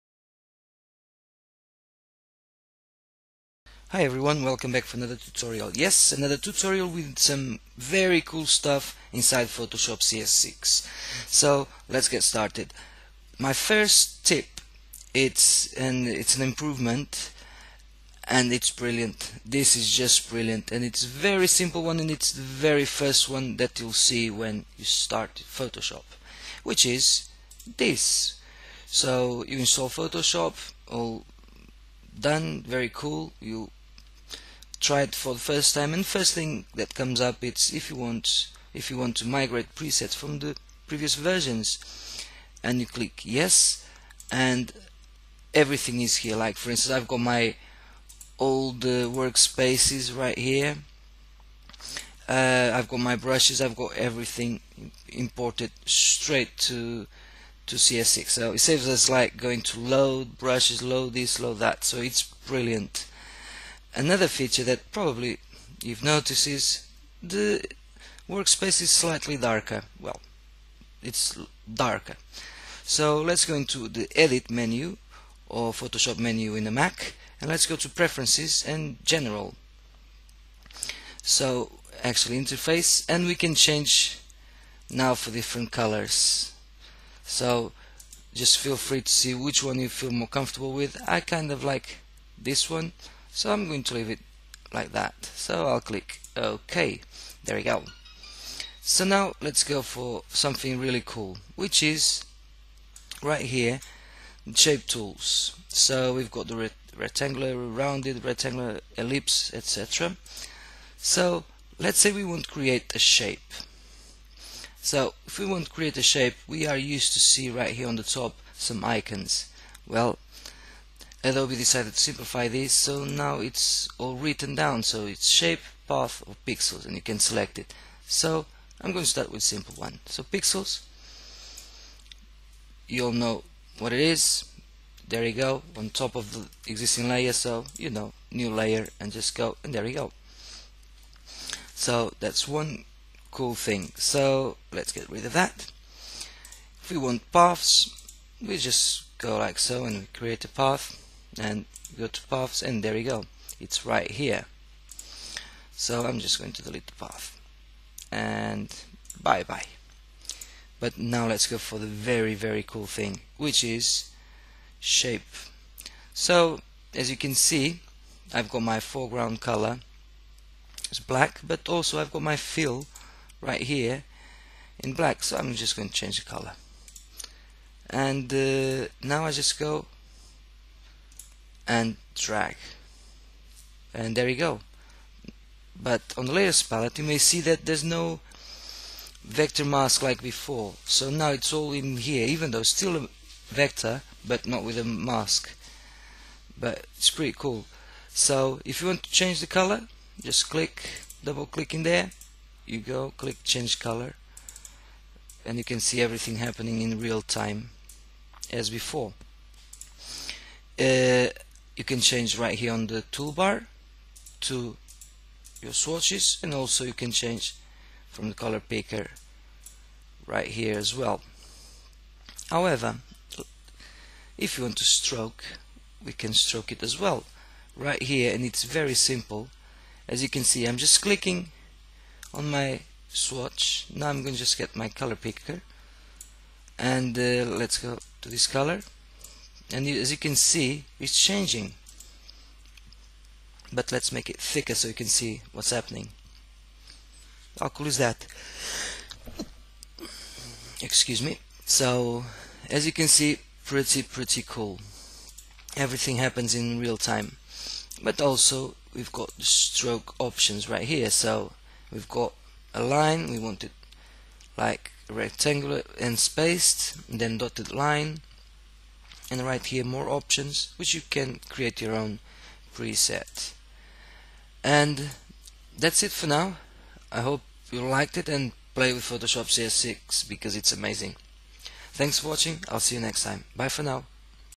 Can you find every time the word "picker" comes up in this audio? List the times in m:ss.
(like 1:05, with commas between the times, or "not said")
3:38, 3:55.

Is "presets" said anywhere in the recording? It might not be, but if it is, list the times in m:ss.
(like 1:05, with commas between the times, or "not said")
0:39, 4:32.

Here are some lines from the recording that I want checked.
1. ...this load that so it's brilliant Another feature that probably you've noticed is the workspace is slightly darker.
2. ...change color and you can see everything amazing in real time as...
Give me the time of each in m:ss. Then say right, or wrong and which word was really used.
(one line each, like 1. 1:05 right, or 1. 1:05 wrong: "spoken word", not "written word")
1. 1:01 right
2. 3:23 wrong: "happening", not "amazing".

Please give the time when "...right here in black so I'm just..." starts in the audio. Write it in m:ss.
2:53.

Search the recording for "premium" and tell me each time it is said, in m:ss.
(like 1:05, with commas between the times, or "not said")
not said.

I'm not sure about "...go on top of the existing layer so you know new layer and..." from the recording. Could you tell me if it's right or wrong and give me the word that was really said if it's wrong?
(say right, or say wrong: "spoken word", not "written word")
right.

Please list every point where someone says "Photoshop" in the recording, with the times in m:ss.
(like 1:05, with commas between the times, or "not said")
0:09, 0:25, 0:29, 1:15, 4:39.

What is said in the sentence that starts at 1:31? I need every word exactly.
I kind of like this one so I'm going to leave it like that.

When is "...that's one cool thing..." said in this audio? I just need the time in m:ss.
2:22.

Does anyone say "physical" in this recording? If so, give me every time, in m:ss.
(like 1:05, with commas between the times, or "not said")
not said.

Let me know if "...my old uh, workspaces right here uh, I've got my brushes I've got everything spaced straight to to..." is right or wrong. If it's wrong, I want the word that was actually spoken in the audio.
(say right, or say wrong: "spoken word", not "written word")
wrong: "imported", not "spaced".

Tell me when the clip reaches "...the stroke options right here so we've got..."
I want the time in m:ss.
4:19.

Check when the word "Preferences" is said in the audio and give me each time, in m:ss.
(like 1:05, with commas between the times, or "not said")
1:17.